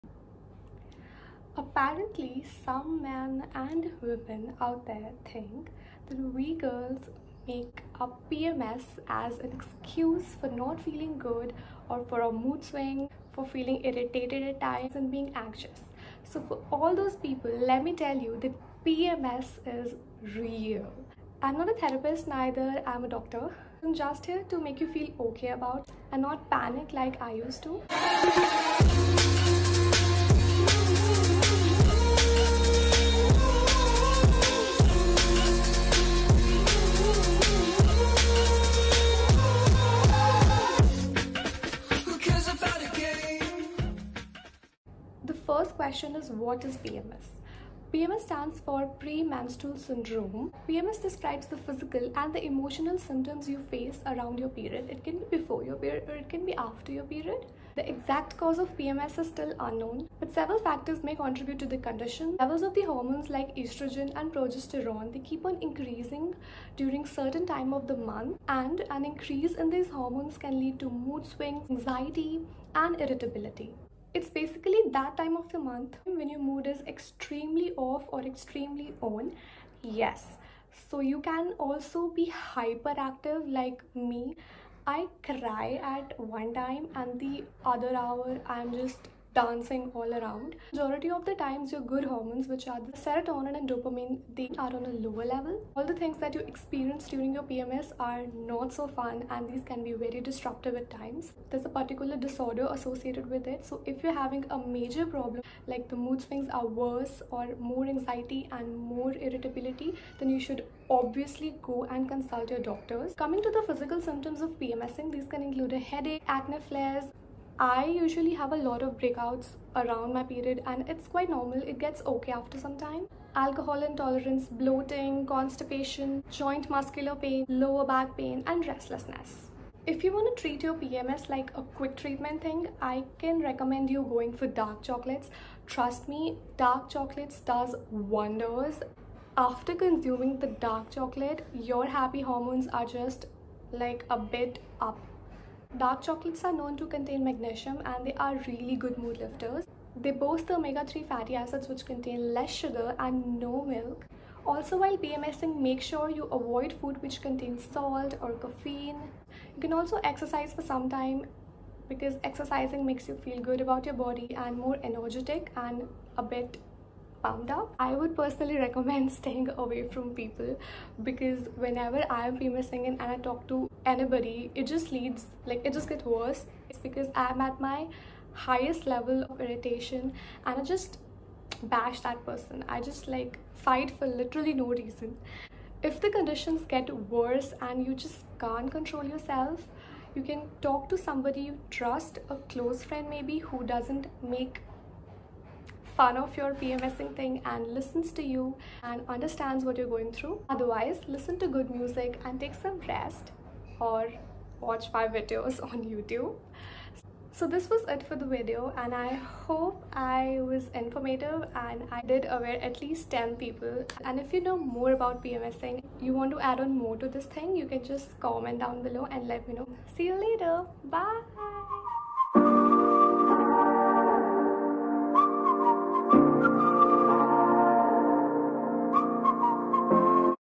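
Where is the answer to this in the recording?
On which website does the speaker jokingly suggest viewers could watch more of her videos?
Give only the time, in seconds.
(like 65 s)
205 s.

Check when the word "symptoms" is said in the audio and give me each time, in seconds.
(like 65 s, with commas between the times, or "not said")
52 s, 114 s.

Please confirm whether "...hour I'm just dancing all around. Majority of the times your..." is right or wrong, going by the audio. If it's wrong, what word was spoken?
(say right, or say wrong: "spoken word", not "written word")
right.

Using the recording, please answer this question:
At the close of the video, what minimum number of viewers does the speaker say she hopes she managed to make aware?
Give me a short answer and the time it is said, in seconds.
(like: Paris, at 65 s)
10, at 213 s.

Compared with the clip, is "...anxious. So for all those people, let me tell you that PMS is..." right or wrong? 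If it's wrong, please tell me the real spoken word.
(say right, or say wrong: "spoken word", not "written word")
right.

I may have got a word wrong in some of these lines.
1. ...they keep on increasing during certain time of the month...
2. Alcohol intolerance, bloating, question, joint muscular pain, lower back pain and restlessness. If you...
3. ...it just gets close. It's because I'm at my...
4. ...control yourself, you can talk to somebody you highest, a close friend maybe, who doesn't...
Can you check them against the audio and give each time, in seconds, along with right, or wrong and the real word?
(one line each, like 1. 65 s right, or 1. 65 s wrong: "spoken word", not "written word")
1. 65 s right
2. 123 s wrong: "constipation", not "question"
3. 175 s wrong: "worse", not "close"
4. 188 s wrong: "trust", not "highest".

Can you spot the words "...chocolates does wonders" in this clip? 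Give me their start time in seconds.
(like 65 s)
136 s.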